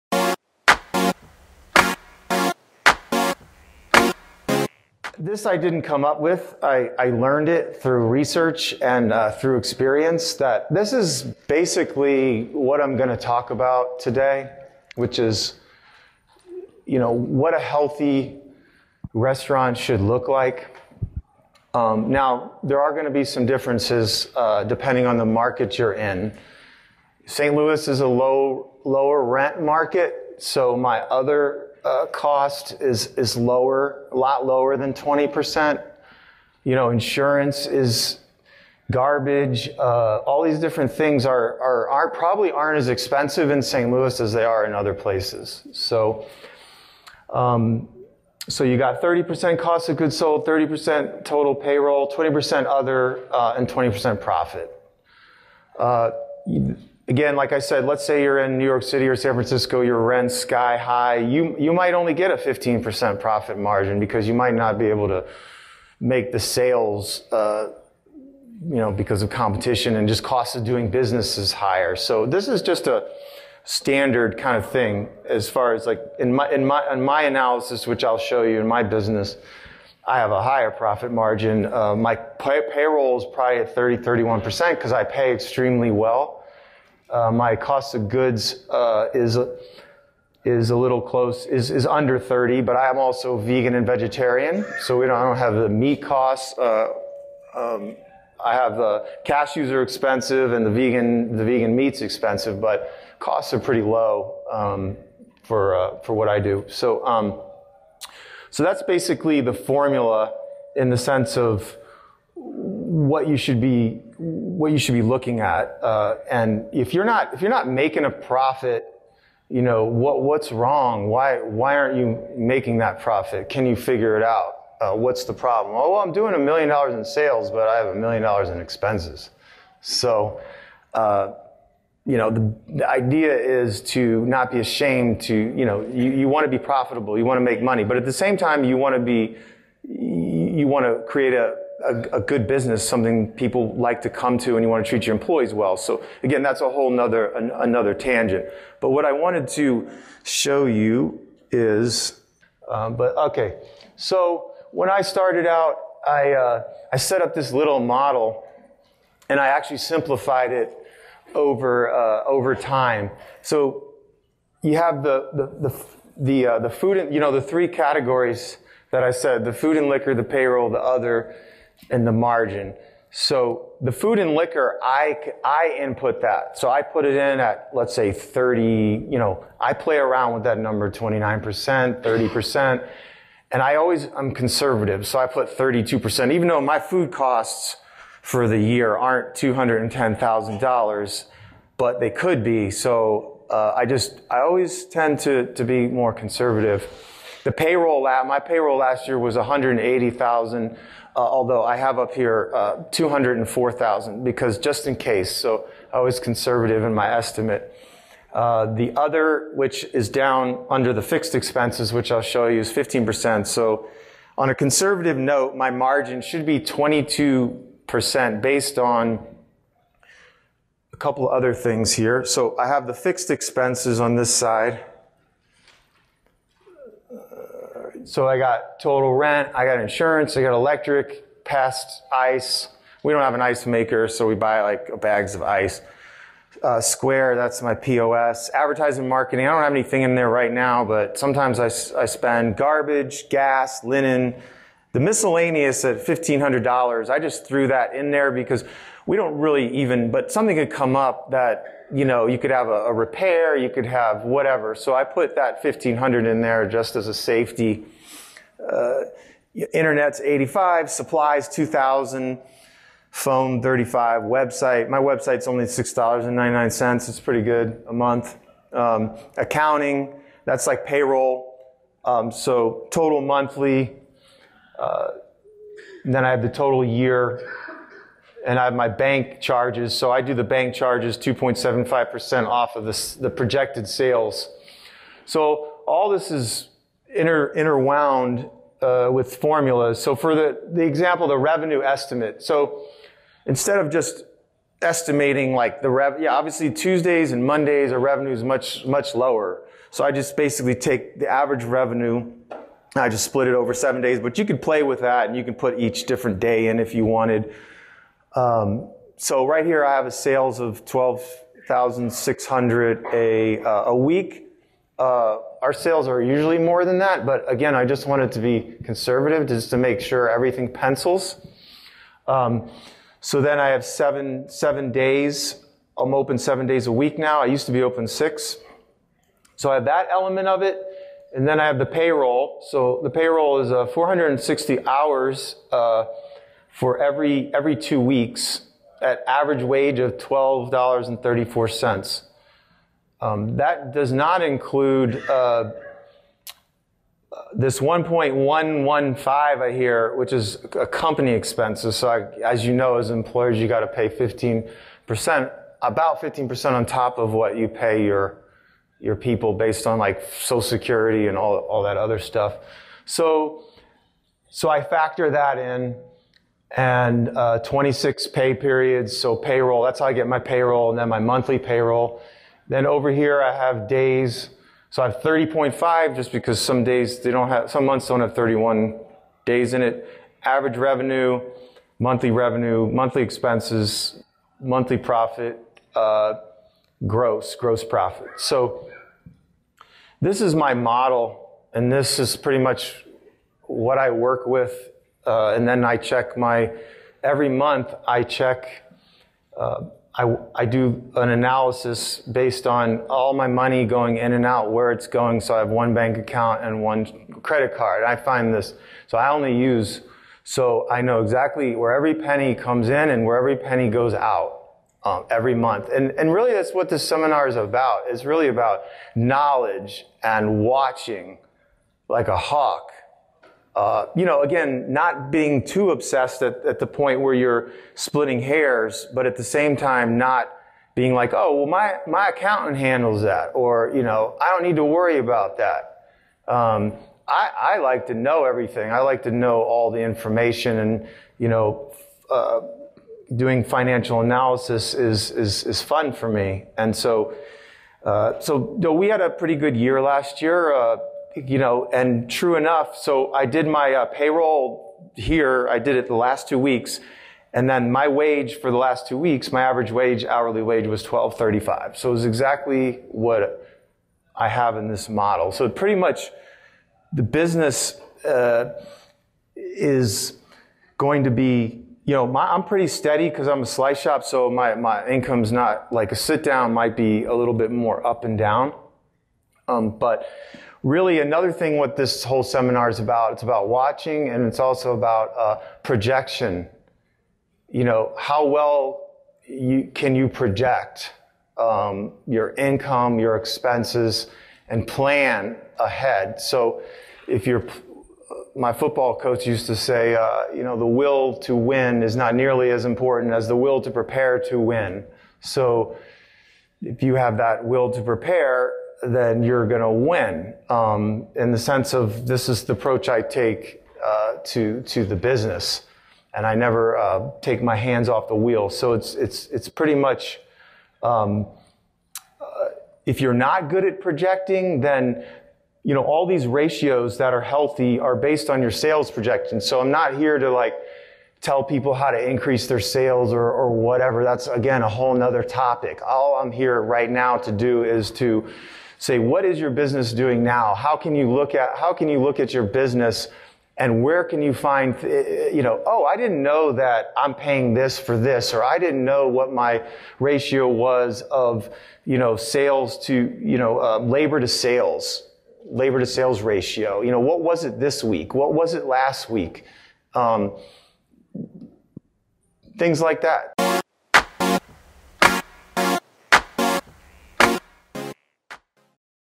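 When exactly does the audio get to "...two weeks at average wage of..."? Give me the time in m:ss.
5:37.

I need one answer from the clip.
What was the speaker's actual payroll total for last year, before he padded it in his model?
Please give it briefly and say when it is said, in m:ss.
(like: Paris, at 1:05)
$180,000, at 3:19.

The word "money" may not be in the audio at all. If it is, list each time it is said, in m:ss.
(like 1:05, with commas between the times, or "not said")
2:17, 6:43.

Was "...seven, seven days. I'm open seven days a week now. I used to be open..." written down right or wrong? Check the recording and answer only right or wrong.
right.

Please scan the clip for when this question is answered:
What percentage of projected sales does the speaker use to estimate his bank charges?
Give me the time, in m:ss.
4:41.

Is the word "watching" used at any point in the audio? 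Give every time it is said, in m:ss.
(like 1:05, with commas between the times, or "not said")
7:00, 8:03.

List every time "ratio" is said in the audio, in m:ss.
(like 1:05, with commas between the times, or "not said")
8:46, 9:10, 9:16.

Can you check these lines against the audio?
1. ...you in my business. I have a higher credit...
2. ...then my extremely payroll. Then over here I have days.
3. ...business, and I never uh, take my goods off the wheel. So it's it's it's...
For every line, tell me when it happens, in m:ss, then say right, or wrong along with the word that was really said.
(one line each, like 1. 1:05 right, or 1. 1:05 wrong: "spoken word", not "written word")
1. 1:18 wrong: "profit", not "credit"
2. 6:10 wrong: "monthly", not "extremely"
3. 8:35 wrong: "hands", not "goods".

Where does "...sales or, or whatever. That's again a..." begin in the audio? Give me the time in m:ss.
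8:52.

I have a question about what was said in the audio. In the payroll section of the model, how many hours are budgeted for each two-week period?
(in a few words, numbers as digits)
460.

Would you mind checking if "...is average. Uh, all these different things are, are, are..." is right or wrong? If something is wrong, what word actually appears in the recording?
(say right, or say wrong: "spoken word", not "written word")
wrong: "garbage", not "average".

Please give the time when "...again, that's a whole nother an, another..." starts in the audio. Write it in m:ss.
2:26.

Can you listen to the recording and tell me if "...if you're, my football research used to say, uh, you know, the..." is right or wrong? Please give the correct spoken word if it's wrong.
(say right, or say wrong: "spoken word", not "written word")
wrong: "coach", not "research".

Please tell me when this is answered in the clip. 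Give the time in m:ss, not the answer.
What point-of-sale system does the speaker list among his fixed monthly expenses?
3:56.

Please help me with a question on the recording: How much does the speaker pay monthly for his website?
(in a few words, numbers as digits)
$6.99.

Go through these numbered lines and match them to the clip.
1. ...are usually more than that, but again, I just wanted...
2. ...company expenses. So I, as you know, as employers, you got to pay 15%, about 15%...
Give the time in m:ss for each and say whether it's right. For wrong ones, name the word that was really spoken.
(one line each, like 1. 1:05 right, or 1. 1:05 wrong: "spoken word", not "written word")
1. 5:16 right
2. 5:50 right.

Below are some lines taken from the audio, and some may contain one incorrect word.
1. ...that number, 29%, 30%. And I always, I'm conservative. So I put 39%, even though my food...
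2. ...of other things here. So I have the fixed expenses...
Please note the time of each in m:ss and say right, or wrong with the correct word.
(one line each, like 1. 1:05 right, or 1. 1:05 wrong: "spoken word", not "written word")
1. 3:00 wrong: "32", not "39"
2. 3:41 right.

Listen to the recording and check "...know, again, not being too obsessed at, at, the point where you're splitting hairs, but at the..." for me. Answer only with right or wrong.
right.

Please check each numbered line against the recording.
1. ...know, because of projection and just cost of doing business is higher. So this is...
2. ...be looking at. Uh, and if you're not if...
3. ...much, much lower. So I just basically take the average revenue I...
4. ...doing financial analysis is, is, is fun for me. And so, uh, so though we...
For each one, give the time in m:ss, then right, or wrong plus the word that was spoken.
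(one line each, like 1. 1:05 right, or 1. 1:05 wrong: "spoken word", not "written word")
1. 1:08 wrong: "competition", not "projection"
2. 1:54 right
3. 4:58 right
4. 7:23 right.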